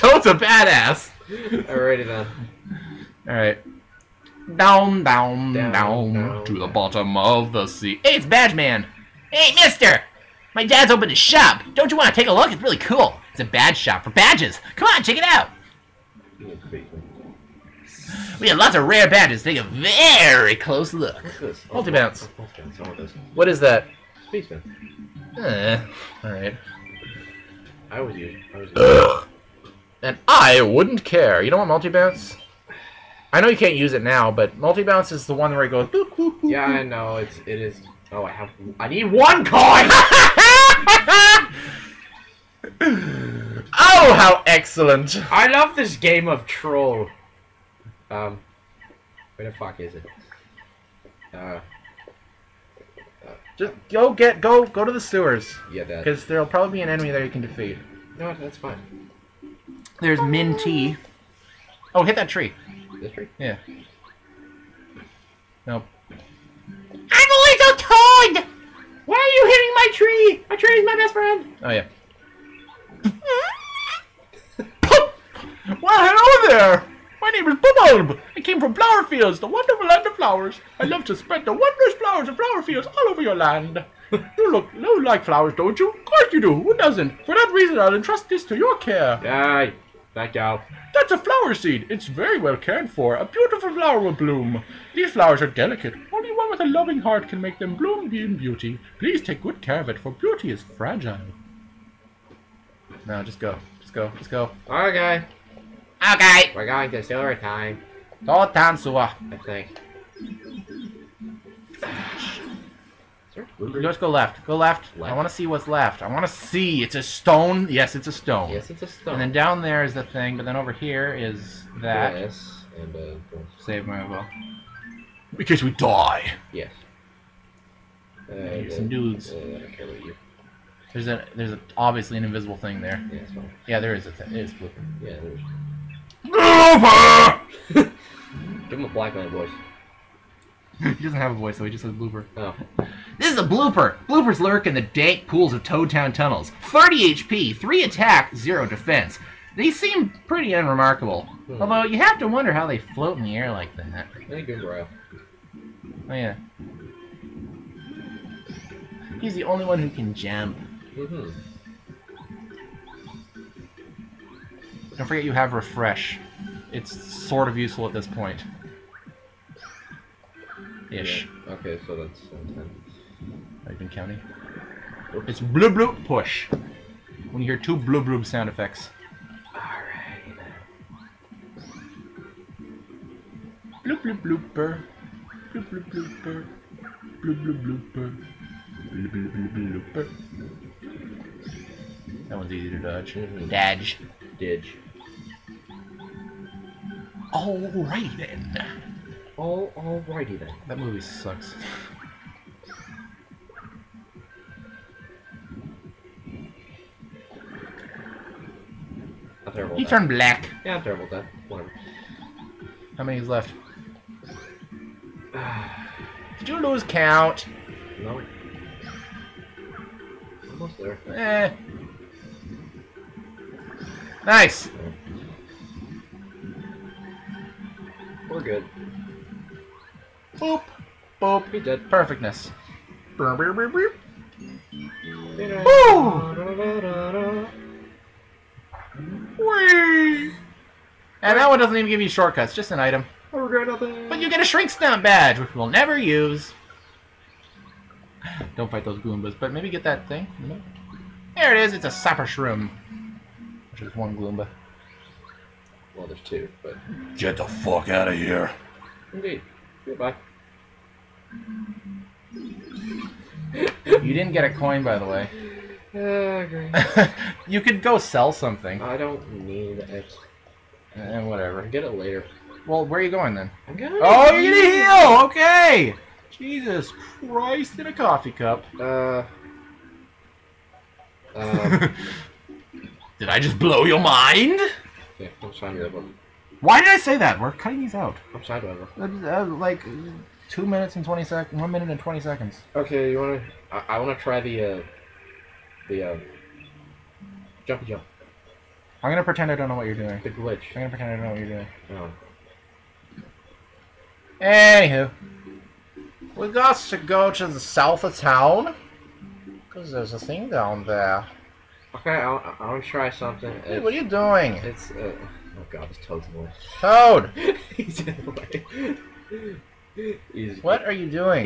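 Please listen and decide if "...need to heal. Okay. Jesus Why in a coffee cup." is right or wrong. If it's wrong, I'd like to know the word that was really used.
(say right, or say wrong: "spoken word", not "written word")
wrong: "Christ", not "Why".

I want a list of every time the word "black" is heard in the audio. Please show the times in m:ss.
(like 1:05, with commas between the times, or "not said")
2:18, 3:30.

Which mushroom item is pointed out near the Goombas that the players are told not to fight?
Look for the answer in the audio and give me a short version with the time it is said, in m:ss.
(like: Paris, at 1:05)
Sapper shroom, at 4:11.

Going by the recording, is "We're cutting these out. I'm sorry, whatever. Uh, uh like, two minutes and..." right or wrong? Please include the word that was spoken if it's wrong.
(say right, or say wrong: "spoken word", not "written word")
right.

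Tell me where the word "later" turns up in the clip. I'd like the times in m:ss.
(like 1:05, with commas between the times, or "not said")
4:31.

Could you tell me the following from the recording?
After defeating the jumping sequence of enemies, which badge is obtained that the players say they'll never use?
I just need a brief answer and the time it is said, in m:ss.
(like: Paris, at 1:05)
Shrink Stomp, at 4:04.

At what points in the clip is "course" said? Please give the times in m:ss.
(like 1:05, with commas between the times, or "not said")
1:26.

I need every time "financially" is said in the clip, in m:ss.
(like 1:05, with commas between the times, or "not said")
not said.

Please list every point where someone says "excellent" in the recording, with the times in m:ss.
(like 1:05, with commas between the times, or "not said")
0:44.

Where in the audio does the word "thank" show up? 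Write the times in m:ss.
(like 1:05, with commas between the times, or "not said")
1:30, 2:34.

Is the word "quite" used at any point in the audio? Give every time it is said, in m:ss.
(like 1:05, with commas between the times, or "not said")
not said.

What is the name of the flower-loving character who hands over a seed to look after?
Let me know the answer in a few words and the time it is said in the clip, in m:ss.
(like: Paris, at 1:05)
Bubulb, at 1:17.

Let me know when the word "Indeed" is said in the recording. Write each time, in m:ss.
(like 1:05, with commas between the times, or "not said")
4:19.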